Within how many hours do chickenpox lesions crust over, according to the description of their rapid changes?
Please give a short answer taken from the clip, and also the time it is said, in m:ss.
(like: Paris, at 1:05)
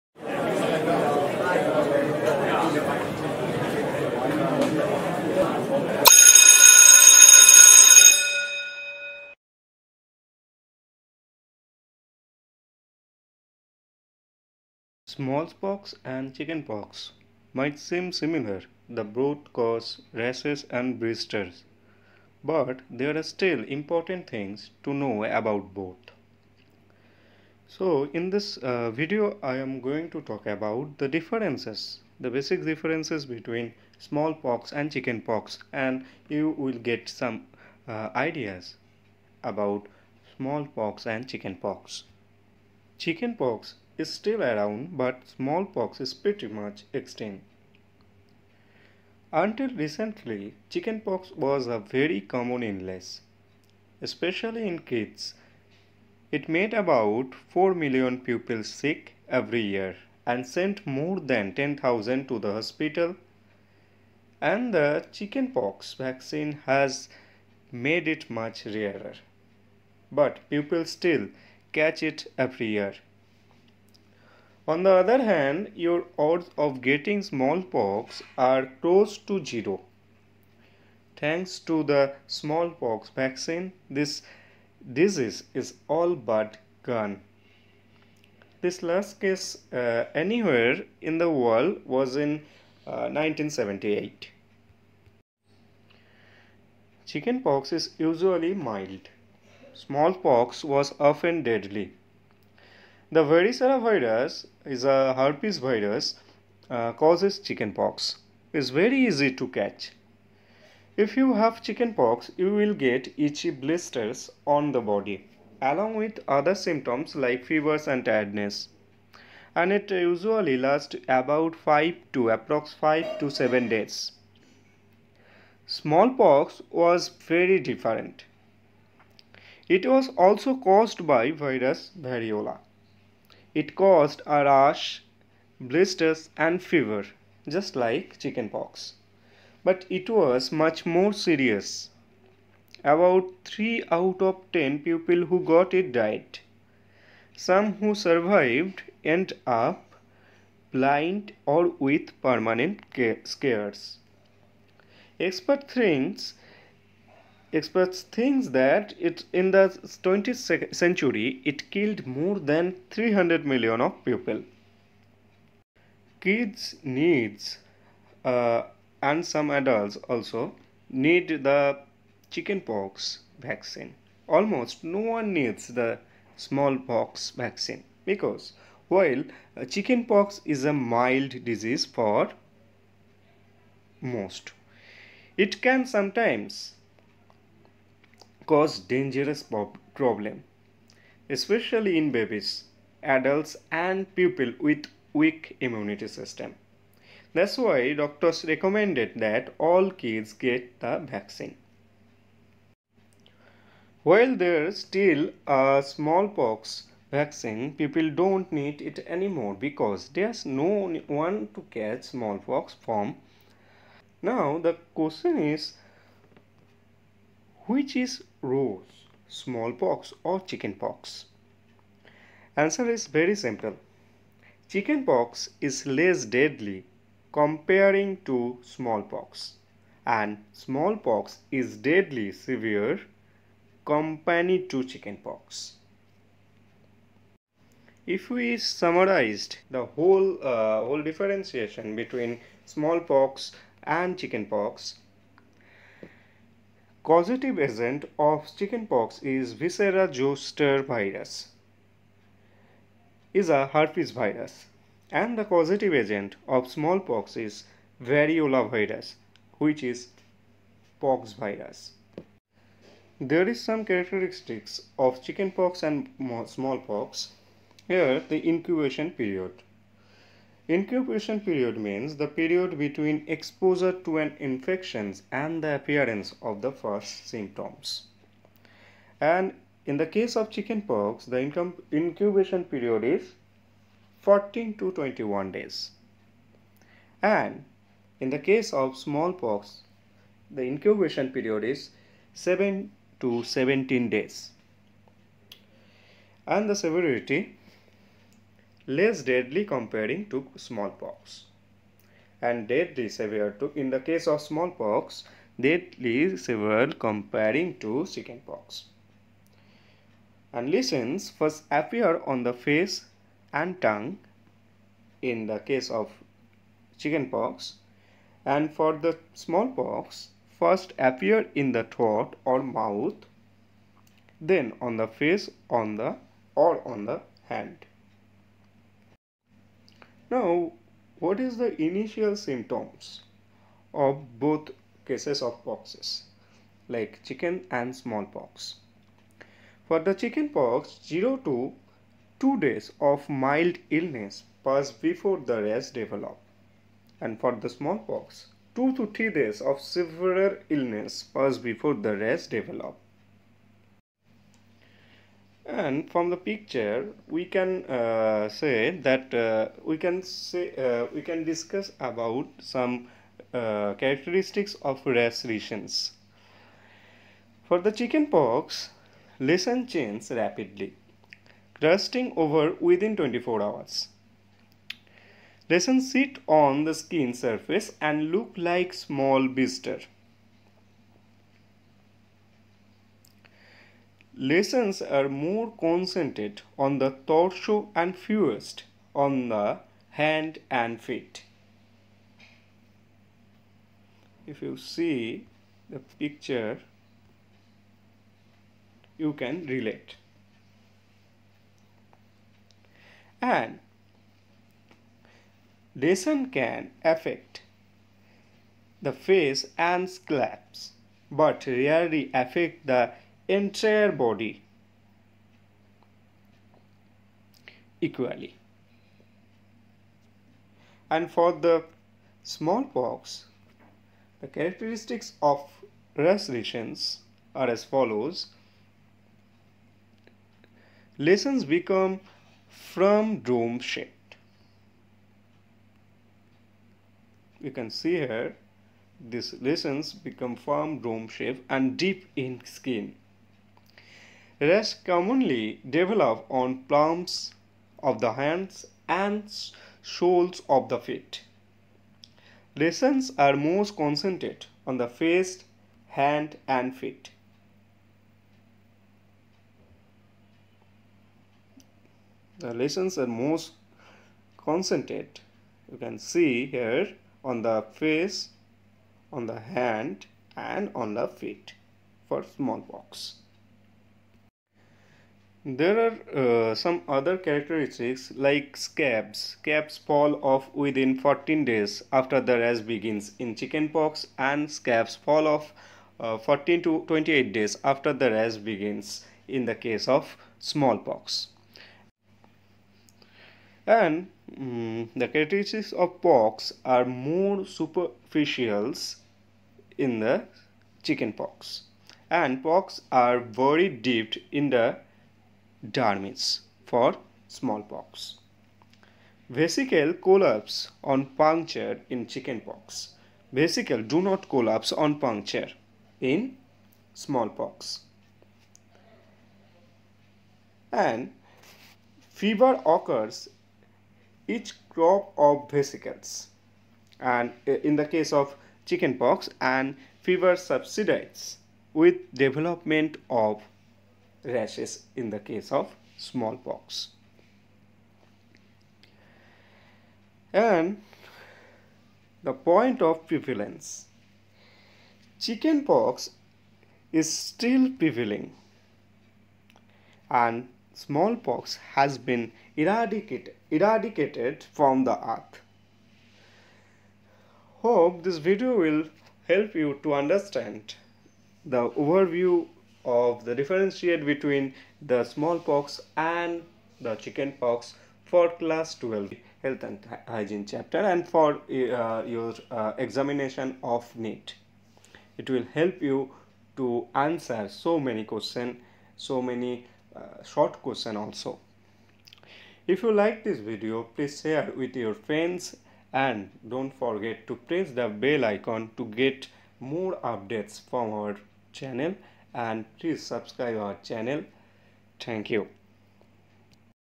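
24 hours, at 6:13.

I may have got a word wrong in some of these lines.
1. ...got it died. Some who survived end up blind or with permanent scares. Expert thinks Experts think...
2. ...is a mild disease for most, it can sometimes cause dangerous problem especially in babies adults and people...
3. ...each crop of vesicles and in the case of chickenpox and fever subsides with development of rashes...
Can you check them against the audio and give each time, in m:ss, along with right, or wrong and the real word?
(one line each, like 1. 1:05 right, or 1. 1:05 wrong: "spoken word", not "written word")
1. 2:25 right
2. 3:00 right
3. 8:44 right.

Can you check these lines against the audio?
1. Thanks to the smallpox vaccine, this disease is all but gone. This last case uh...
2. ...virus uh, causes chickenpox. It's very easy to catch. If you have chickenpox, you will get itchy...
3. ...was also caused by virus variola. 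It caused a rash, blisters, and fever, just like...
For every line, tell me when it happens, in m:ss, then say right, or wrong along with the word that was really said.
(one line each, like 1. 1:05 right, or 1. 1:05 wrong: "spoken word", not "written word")
1. 1:21 right
2. 1:45 right
3. 2:09 right.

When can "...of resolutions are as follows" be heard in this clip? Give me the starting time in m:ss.
7:05.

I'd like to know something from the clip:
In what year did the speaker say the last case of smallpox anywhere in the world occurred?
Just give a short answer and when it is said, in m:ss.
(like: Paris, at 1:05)
1978, at 1:33.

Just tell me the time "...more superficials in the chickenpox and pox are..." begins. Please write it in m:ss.
8:17.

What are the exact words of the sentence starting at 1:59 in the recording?
And it usually lasts about 5 to approx 5 to 7 days.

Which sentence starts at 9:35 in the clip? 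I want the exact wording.
It will help you to answer so many question, so many uh, short question also.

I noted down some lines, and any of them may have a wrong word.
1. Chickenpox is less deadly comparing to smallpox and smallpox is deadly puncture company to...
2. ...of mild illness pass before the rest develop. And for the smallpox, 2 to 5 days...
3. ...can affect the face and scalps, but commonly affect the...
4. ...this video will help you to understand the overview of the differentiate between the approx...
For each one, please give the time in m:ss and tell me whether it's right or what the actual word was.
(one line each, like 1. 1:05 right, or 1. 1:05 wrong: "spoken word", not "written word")
1. 3:44 wrong: "severe", not "puncture"
2. 5:43 wrong: "3", not "5"
3. 6:46 wrong: "rarely", not "commonly"
4. 9:18 wrong: "smallpox", not "approx".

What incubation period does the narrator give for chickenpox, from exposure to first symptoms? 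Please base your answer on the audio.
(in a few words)
14 to 21 days.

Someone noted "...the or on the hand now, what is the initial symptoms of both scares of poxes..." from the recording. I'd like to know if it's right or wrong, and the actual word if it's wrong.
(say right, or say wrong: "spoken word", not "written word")
wrong: "cases", not "scares".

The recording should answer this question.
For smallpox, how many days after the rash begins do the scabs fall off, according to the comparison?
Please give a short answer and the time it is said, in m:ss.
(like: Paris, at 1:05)
14 to 28 days, at 8:06.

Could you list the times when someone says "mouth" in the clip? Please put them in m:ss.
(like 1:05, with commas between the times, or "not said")
5:22.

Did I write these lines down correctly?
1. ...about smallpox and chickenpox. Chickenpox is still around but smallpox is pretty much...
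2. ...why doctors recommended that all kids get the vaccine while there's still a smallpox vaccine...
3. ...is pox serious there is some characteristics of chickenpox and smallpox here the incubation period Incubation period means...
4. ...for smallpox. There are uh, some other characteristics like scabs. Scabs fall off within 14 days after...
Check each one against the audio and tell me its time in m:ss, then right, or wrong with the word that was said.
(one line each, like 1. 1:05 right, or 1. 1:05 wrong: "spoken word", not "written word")
1. 0:39 right
2. 3:17 right
3. 4:19 wrong: "virus", not "serious"
4. 7:52 right.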